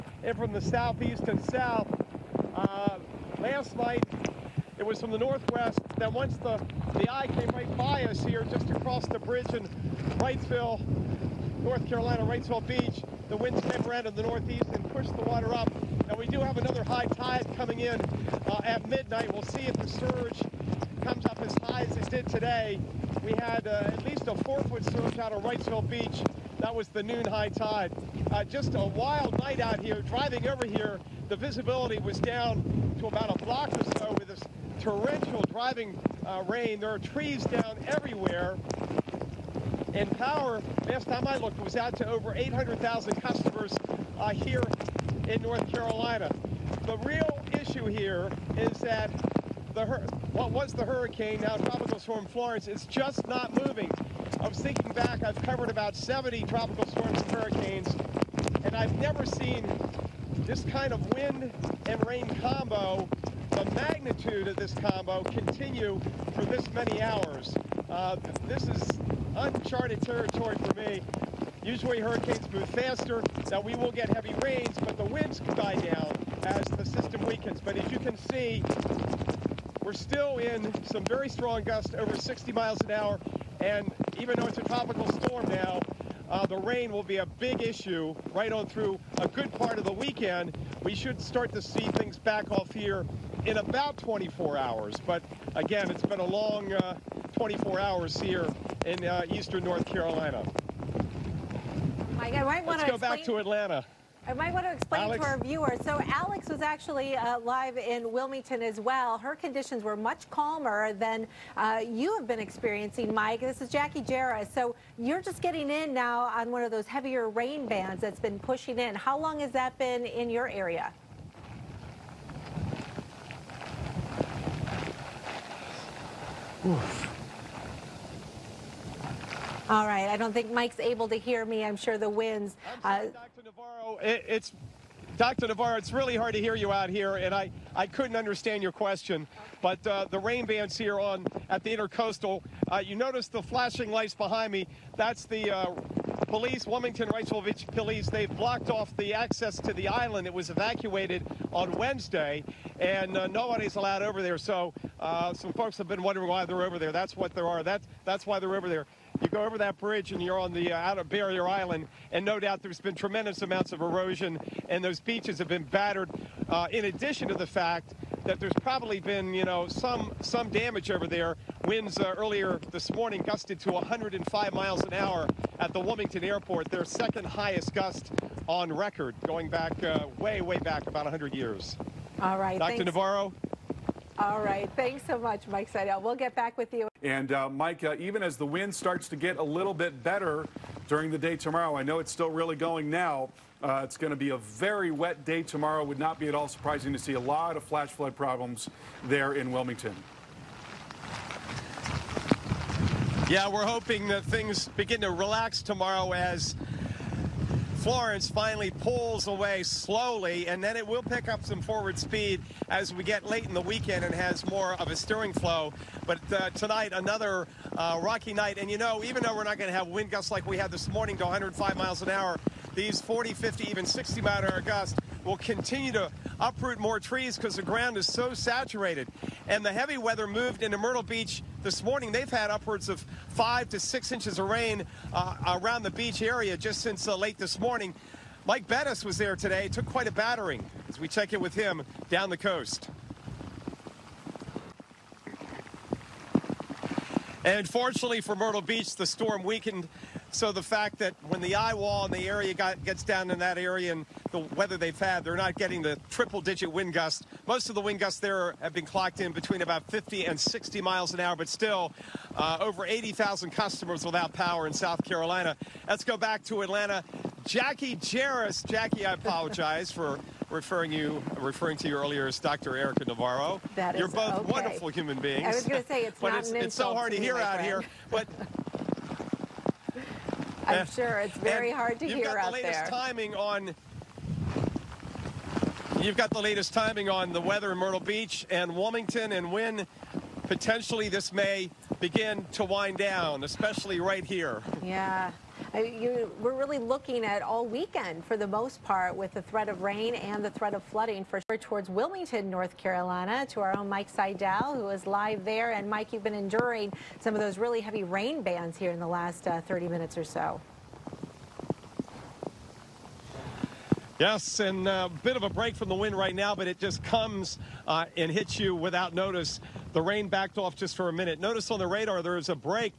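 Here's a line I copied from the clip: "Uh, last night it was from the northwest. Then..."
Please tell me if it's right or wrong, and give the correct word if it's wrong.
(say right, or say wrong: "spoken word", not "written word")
right.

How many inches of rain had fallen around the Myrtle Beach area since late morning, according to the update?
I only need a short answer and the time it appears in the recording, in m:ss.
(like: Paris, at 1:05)
5 to 6 inches, at 3:53.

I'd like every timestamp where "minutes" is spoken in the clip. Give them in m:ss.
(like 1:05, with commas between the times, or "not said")
5:09, 5:21.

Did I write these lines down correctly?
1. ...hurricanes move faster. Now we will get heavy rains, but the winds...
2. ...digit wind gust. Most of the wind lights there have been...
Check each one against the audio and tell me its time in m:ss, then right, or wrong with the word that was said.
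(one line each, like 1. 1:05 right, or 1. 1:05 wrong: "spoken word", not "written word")
1. 1:11 right
2. 4:16 wrong: "gusts", not "lights".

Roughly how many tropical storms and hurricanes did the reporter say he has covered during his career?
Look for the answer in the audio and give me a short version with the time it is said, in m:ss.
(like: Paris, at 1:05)
about 70, at 0:55.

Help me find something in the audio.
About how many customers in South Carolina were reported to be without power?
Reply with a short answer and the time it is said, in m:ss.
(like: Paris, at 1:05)
over 80,000, at 4:22.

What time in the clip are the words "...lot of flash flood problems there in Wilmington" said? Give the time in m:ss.
3:17.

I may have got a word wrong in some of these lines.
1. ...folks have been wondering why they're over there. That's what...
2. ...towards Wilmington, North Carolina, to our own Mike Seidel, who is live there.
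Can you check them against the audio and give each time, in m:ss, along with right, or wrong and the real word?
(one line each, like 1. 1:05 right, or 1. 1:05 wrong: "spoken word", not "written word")
1. 2:35 right
2. 5:01 right.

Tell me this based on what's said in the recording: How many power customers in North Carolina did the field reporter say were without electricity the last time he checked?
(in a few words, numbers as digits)
over 800,000.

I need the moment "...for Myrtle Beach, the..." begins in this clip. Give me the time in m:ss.
4:08.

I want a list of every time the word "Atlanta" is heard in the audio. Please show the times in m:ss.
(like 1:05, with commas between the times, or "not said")
1:43, 4:26.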